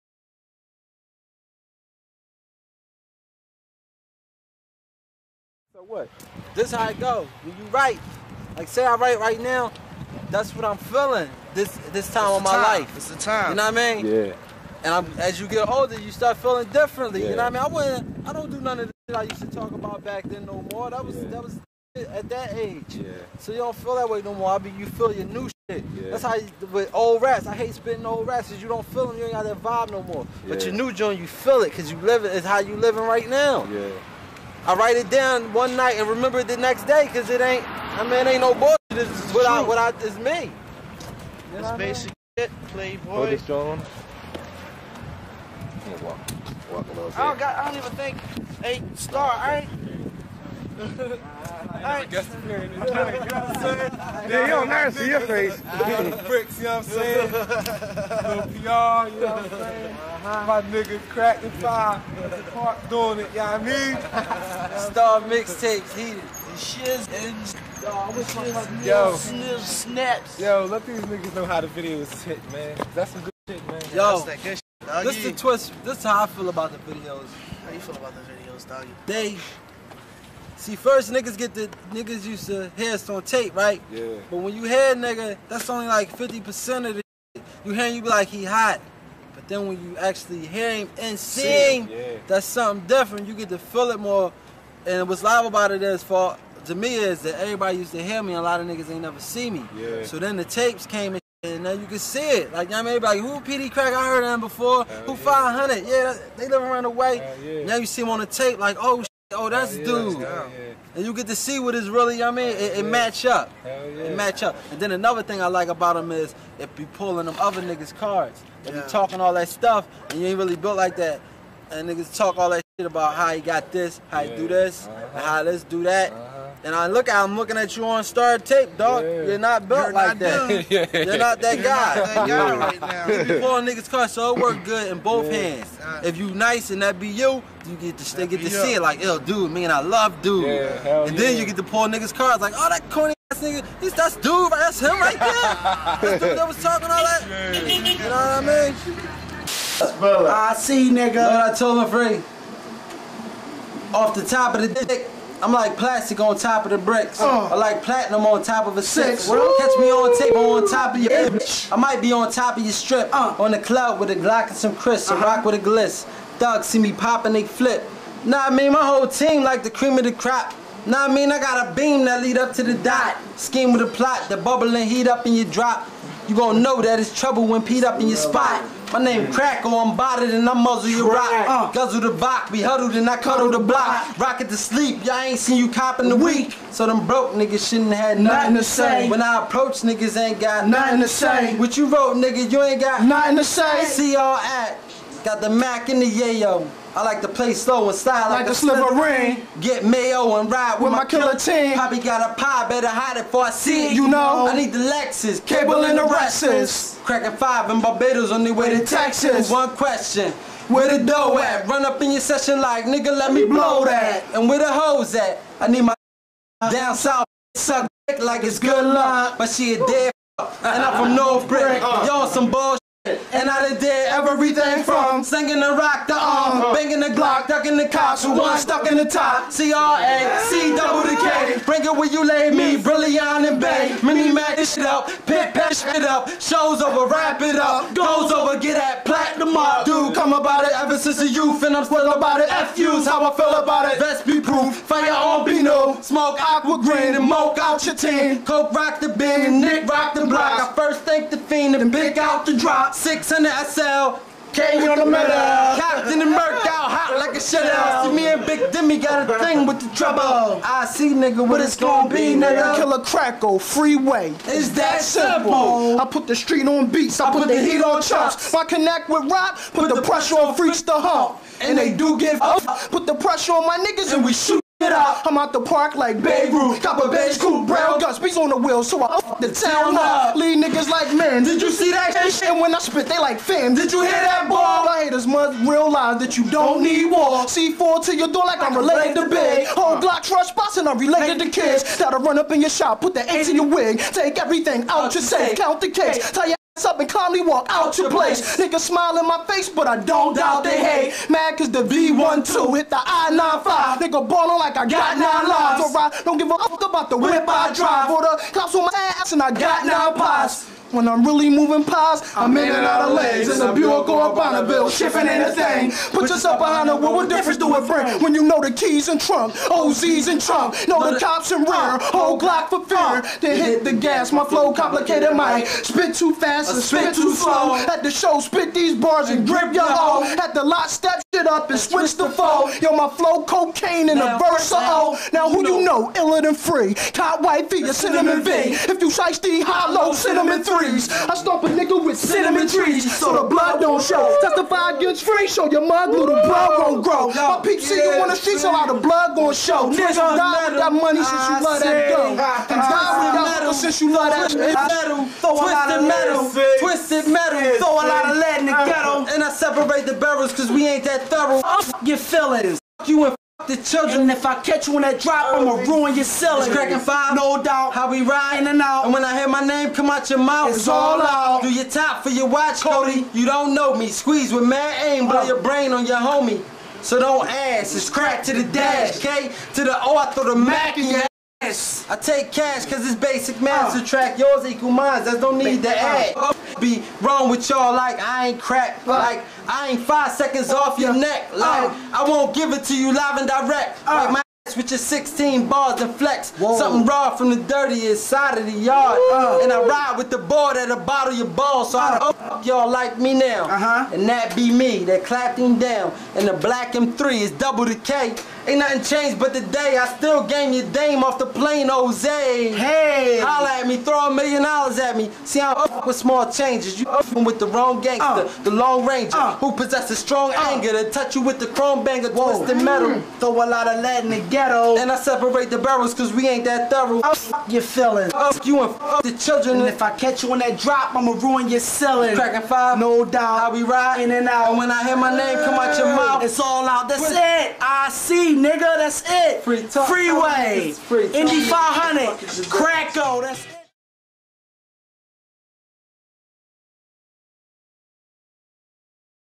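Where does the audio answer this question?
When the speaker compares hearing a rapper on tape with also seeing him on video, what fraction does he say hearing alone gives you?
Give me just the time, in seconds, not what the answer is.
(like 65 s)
86 s.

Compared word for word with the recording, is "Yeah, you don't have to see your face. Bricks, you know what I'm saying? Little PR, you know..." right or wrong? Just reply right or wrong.
right.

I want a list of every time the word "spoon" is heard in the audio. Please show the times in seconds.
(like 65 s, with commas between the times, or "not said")
not said.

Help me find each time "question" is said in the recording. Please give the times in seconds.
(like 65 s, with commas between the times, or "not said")
209 s.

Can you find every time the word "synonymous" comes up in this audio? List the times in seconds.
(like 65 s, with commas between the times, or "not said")
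not said.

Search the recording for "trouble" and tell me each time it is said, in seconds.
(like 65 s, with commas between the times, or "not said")
177 s, 259 s.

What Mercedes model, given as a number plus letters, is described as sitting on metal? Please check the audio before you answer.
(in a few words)
600 SL.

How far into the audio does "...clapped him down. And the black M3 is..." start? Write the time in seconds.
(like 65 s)
405 s.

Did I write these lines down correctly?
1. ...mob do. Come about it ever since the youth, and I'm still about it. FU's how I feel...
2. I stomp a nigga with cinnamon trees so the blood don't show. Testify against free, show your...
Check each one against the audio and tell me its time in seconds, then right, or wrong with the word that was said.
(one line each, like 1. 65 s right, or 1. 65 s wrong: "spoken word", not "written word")
1. 239 s right
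2. 341 s right.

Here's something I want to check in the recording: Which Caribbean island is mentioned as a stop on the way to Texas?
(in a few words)
Barbados.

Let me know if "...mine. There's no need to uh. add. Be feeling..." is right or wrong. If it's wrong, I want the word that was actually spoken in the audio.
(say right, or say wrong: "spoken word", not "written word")
wrong: "wrong", not "feeling".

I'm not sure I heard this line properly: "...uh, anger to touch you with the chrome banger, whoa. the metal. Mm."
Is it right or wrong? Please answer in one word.
right.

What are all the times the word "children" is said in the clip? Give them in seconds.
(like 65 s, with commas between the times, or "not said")
363 s, 429 s.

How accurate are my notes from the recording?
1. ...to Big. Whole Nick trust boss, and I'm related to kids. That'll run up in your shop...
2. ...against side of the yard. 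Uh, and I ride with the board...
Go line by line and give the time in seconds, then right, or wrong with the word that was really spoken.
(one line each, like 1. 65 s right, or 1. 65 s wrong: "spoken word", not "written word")
1. 289 s wrong: "Glock", not "Nick"
2. 397 s wrong: "dirtiest", not "against".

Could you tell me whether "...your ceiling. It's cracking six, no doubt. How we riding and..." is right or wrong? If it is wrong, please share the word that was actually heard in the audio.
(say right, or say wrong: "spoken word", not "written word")
wrong: "five", not "six".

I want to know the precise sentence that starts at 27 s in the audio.
I hate spitting old rats because you don't feel them.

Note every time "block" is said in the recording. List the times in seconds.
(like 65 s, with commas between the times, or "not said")
183 s, 250 s.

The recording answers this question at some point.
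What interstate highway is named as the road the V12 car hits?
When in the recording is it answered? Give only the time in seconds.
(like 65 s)
302 s.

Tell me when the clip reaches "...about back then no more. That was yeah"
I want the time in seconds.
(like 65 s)
19 s.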